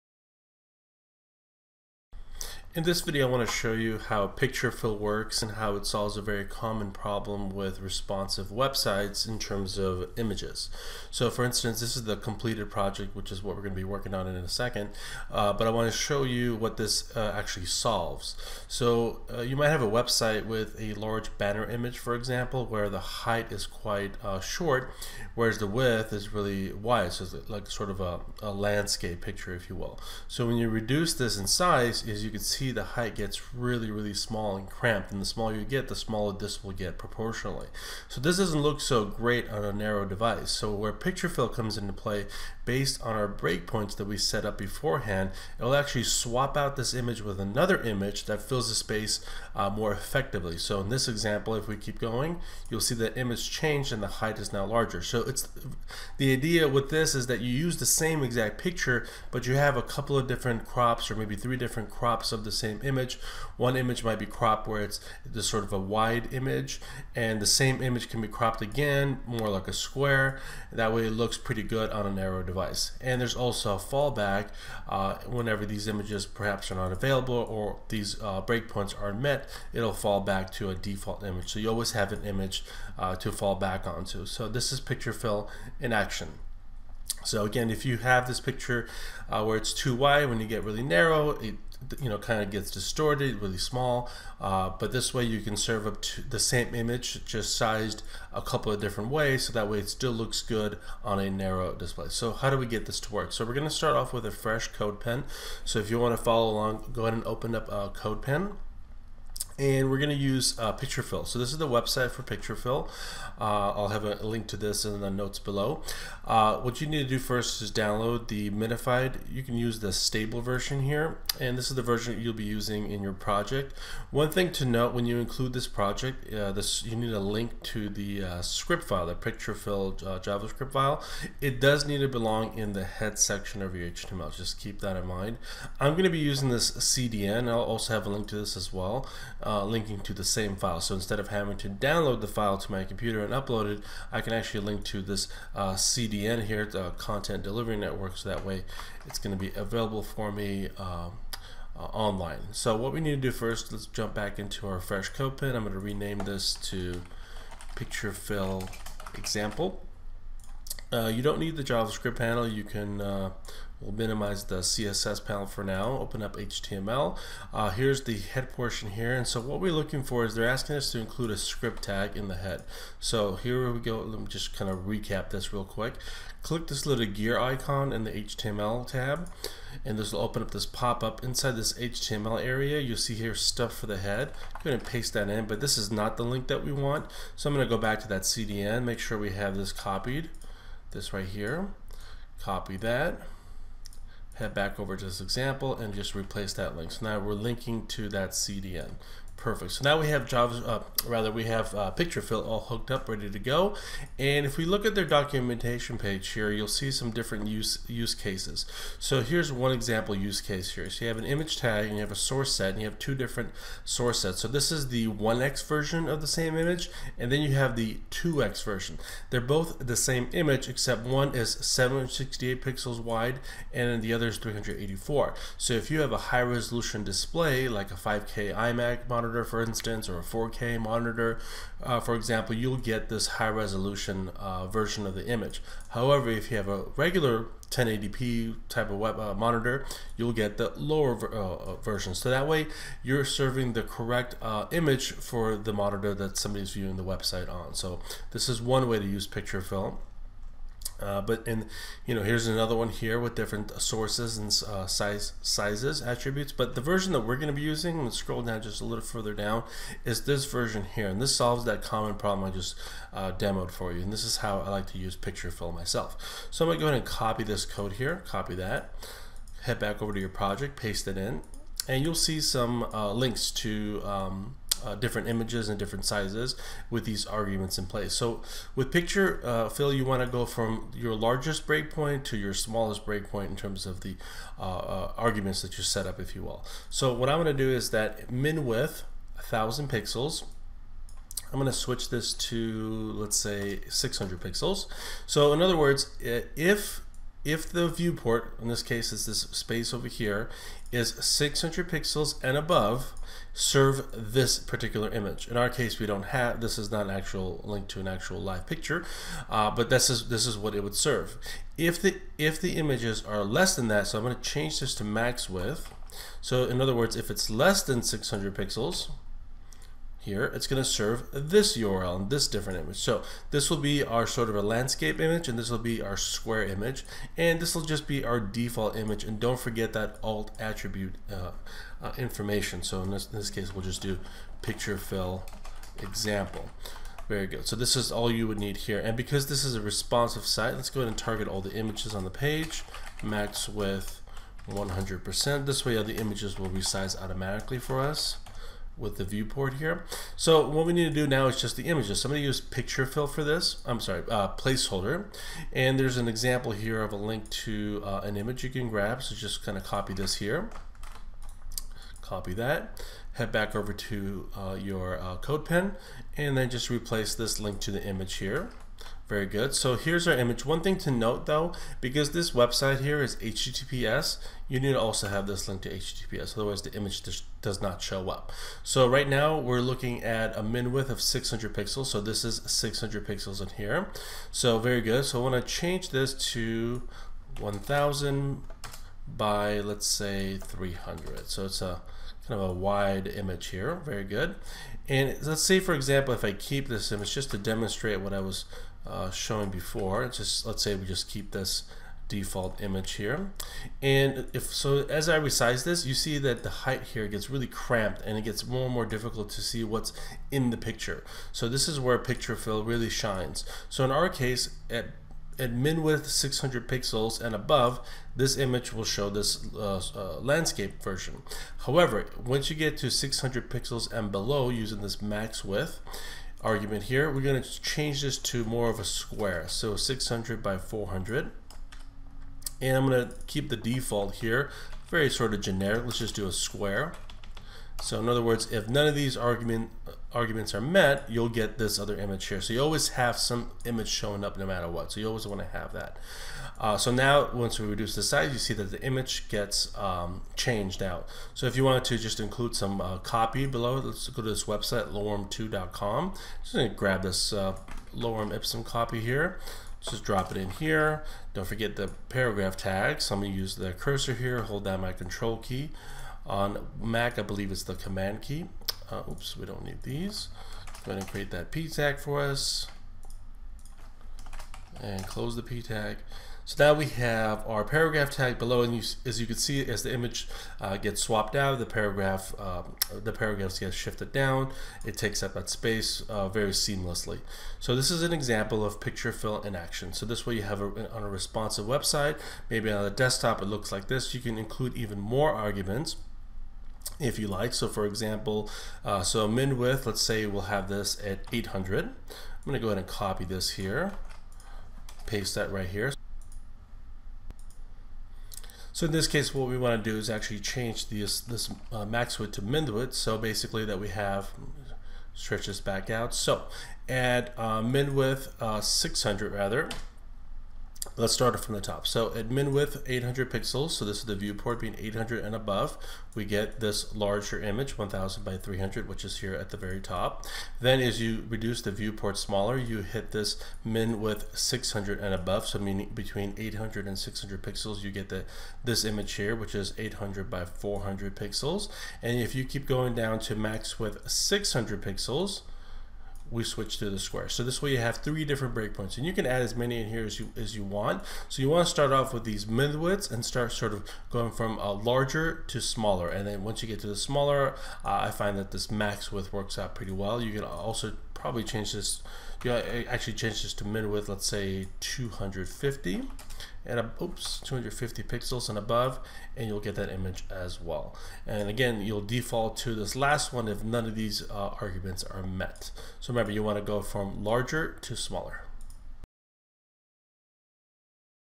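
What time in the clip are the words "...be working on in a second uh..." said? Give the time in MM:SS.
00:13.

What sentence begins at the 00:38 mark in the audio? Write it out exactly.
So this doesn't look so great on a narrow device.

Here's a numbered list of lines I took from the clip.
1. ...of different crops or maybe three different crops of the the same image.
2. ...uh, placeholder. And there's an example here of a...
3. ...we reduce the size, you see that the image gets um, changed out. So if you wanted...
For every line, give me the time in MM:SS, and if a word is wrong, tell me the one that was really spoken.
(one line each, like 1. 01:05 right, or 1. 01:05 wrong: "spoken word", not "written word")
1. 01:00 right
2. 05:54 right
3. 07:27 right.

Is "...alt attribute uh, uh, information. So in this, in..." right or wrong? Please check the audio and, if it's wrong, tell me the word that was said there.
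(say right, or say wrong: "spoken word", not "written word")
right.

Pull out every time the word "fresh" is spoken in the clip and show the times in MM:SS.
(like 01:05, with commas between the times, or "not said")
01:44, 02:34.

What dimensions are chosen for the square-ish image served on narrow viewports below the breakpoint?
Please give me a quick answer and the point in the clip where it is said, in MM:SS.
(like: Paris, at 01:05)
600 by 400, at 07:09.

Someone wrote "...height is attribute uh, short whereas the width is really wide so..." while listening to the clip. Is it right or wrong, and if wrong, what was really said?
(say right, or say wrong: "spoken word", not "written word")
wrong: "quite", not "attribute".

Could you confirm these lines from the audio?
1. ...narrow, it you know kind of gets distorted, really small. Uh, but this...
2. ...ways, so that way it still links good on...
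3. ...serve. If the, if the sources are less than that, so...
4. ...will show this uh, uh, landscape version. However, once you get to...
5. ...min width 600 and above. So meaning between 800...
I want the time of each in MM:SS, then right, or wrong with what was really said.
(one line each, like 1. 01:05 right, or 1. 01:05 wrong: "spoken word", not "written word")
1. 01:30 right
2. 01:39 wrong: "looks", not "links"
3. 05:10 wrong: "images", not "sources"
4. 06:58 right
5. 08:53 right.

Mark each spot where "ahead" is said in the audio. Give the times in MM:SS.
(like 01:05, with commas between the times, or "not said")
01:47, 03:04, 04:26, 05:40, 07:51, 08:22.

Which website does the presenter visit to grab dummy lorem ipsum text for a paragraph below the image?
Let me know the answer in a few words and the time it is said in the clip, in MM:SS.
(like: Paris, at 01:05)
lorem2.com, at 07:35.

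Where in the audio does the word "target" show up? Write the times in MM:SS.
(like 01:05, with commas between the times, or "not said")
05:41.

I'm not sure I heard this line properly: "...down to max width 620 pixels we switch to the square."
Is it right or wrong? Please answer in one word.
wrong.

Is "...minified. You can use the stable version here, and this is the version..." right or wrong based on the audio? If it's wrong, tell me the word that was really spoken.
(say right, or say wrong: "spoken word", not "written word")
right.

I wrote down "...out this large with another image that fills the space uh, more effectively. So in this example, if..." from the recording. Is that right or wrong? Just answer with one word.
wrong.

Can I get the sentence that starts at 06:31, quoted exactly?
So it's a kind of a wide image here.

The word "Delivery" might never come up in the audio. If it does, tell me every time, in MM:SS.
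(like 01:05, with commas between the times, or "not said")
02:27.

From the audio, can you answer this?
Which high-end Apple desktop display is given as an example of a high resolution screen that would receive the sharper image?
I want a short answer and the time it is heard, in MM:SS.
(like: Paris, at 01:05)
5K iMac, at 03:47.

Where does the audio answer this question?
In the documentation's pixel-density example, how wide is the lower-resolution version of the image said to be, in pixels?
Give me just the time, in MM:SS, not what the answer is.
03:44.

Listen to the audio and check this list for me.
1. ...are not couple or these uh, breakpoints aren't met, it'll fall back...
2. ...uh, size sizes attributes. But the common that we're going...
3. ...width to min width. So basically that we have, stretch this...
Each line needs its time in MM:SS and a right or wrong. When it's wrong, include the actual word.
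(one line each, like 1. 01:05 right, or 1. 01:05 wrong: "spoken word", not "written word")
1. 01:16 wrong: "available", not "couple"
2. 04:14 wrong: "version", not "common"
3. 08:32 right.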